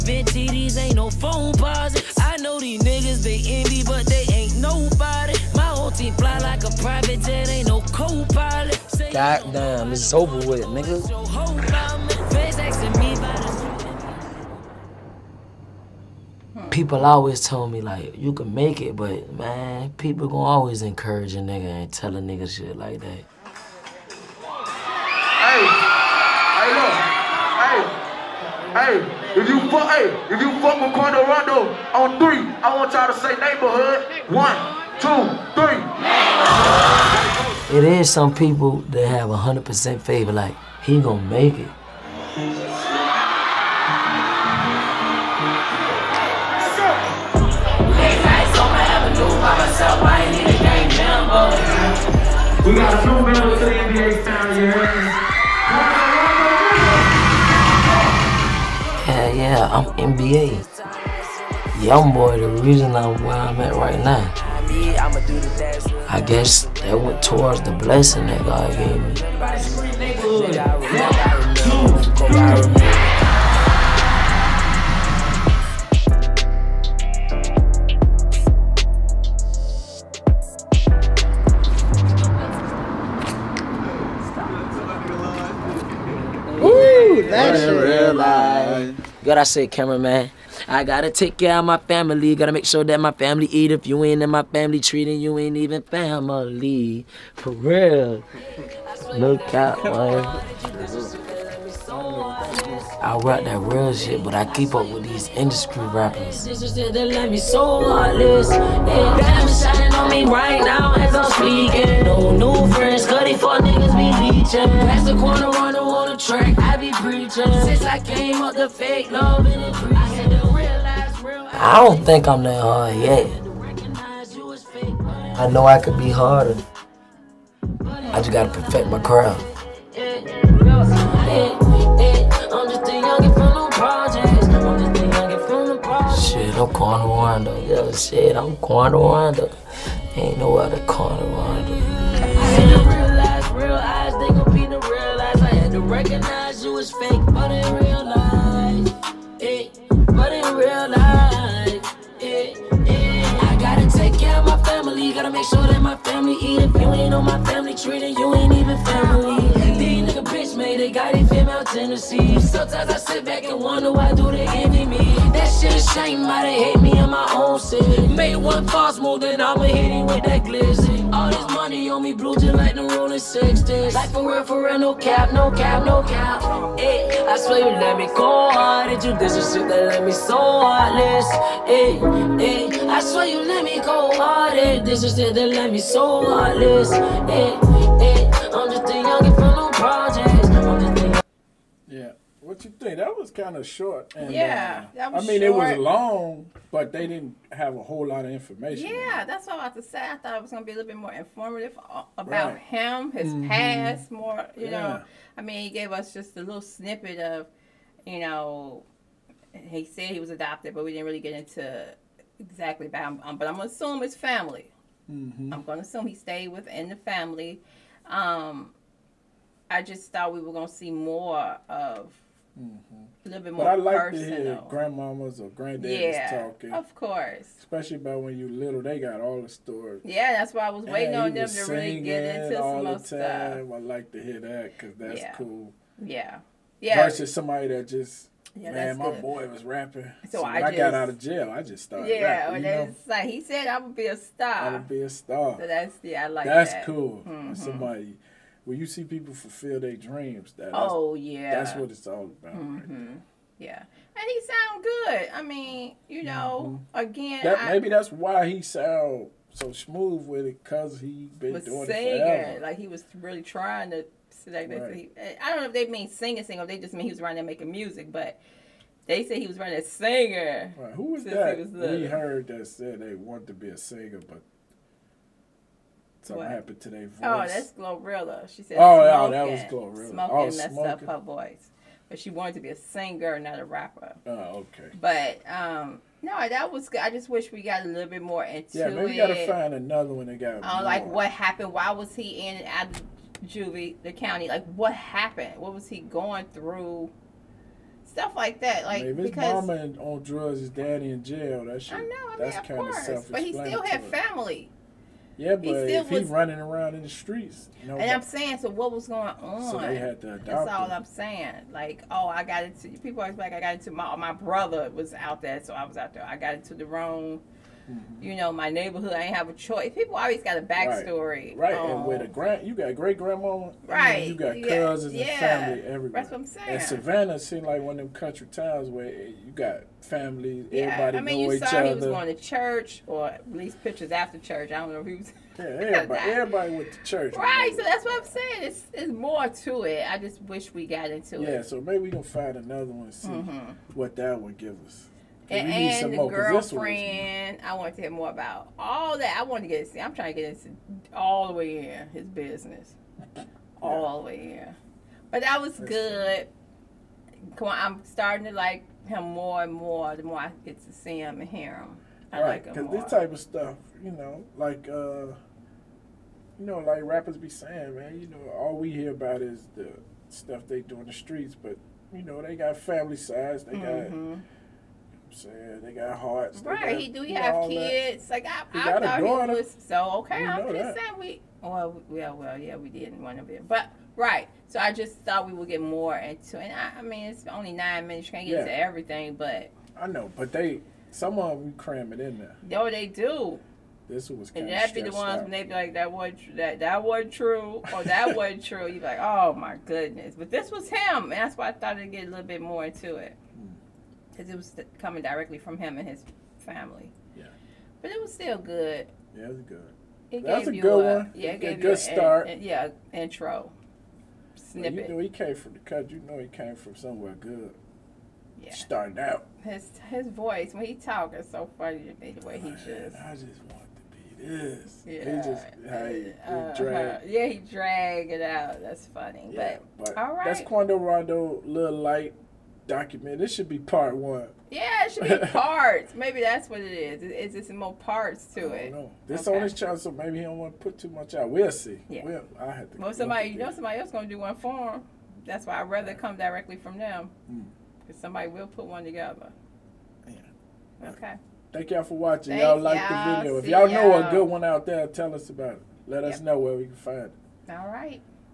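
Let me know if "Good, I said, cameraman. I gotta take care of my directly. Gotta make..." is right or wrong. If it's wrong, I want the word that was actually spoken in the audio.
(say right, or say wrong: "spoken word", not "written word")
wrong: "family", not "directly".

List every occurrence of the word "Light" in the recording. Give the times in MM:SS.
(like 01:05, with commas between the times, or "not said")
07:11.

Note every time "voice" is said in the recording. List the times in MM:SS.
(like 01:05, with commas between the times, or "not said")
04:37, 04:41, 07:00.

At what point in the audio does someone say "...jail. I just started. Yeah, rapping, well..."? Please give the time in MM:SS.
04:01.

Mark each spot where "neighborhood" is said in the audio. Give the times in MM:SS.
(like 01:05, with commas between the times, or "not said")
00:33, 05:18.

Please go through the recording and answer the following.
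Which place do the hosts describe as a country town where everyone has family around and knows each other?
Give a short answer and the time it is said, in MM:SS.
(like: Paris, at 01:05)
Savannah, at 05:26.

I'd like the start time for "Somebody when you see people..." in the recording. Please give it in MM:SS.
04:07.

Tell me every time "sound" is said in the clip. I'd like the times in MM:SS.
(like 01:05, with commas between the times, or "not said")
04:14, 04:18.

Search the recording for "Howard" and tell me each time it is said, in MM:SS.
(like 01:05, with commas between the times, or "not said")
not said.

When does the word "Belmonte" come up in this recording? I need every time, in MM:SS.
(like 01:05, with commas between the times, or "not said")
not said.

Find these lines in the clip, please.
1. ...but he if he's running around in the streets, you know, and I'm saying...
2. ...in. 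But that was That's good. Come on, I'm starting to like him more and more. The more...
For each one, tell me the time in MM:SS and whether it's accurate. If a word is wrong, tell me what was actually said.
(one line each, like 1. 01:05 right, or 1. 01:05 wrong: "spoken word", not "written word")
1. 05:05 right
2. 05:54 right.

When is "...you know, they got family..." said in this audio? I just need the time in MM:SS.
06:12.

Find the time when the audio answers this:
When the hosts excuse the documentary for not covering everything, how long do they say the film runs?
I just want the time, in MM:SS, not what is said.
06:27.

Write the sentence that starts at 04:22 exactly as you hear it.
Like he was really trying to.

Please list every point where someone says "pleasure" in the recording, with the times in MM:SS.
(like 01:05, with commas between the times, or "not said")
not said.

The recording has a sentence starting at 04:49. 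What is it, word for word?
gotta find another one that got.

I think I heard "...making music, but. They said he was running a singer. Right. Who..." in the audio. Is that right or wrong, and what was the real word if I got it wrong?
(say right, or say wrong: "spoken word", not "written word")
right.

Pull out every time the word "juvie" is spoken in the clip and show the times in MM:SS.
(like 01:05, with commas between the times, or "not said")
04:53.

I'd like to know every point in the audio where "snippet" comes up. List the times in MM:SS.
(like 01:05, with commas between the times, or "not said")
03:26, 06:54.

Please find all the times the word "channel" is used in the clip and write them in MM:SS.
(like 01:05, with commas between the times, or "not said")
07:19.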